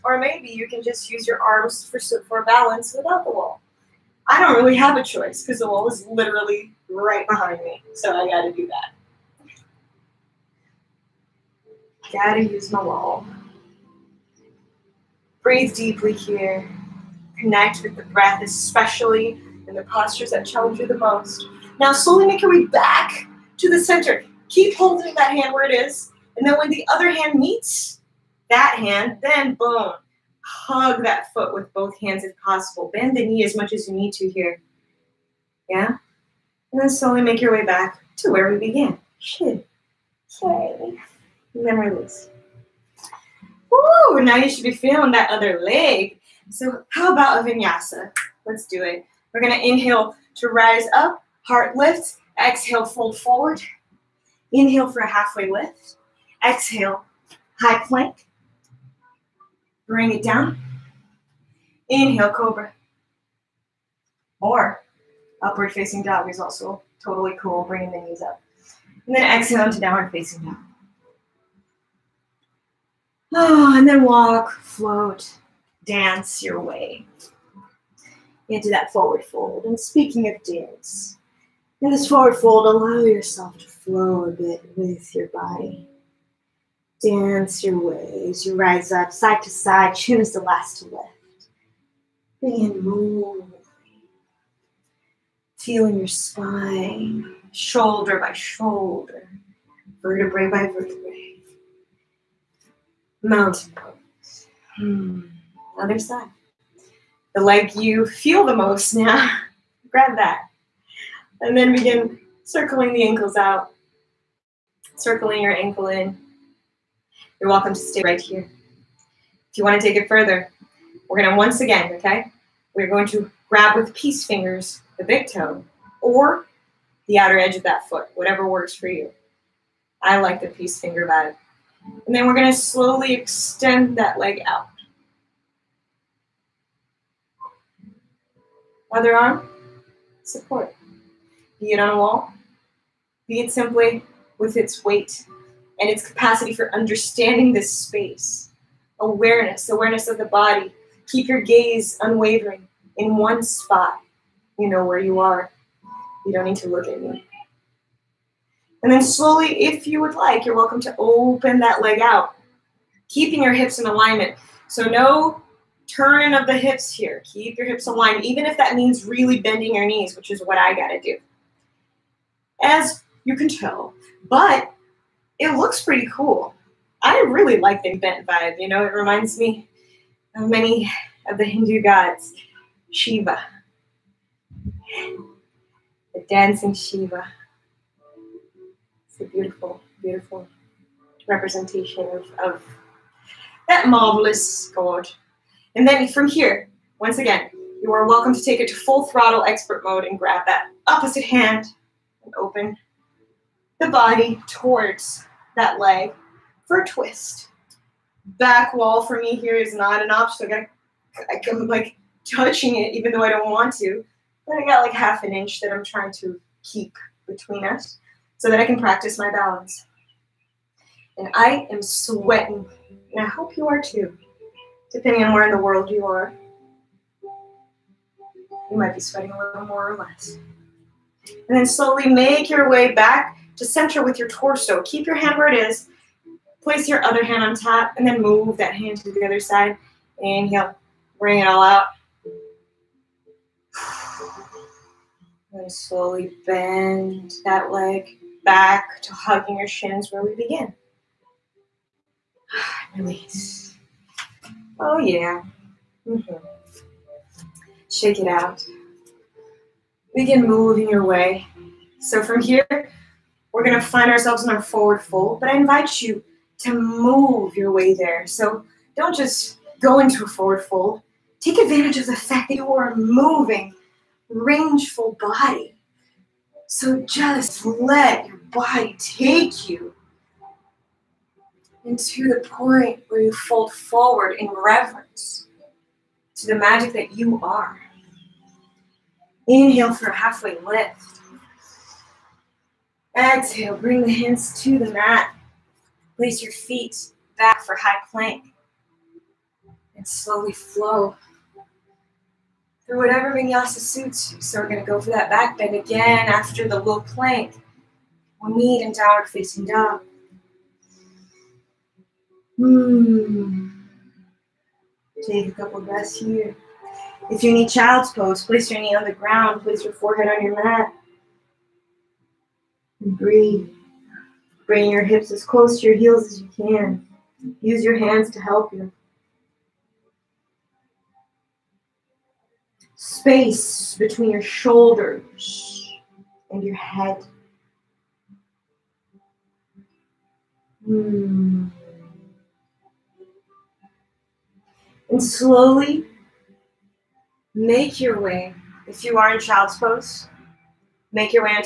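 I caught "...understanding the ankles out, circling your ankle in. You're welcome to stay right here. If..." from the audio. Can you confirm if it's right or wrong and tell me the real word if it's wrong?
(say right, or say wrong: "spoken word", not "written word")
wrong: "circling", not "understanding".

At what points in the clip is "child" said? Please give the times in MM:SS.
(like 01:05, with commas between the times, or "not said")
05:17, 05:49.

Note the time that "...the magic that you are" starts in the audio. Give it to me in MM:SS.
04:46.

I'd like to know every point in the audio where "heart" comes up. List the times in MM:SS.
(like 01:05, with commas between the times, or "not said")
00:51.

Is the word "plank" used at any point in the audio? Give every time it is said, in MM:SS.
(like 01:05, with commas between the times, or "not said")
00:57, 04:58, 05:07.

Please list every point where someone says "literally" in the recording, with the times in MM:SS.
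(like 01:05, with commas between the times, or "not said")
00:06.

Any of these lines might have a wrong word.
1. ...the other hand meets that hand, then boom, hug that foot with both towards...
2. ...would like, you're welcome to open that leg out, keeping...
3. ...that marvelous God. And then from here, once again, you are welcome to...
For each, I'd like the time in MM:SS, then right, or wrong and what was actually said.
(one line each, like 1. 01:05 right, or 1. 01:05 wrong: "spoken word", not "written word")
1. 00:26 wrong: "hands", not "towards"
2. 02:40 right
3. 03:13 right.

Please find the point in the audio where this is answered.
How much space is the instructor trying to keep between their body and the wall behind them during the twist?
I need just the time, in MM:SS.
03:34.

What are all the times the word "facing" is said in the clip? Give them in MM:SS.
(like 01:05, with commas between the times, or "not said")
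01:05, 01:10, 05:09.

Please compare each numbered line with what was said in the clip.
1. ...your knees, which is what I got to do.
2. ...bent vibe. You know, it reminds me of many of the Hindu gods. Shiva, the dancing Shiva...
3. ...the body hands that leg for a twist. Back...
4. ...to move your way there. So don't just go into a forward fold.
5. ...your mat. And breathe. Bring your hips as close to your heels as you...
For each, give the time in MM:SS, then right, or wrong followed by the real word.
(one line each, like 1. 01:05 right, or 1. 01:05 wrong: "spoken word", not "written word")
1. 02:49 right
2. 02:57 right
3. 03:23 wrong: "towards", not "hands"
4. 04:26 right
5. 05:20 right.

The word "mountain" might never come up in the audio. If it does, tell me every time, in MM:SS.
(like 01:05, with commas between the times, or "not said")
01:43.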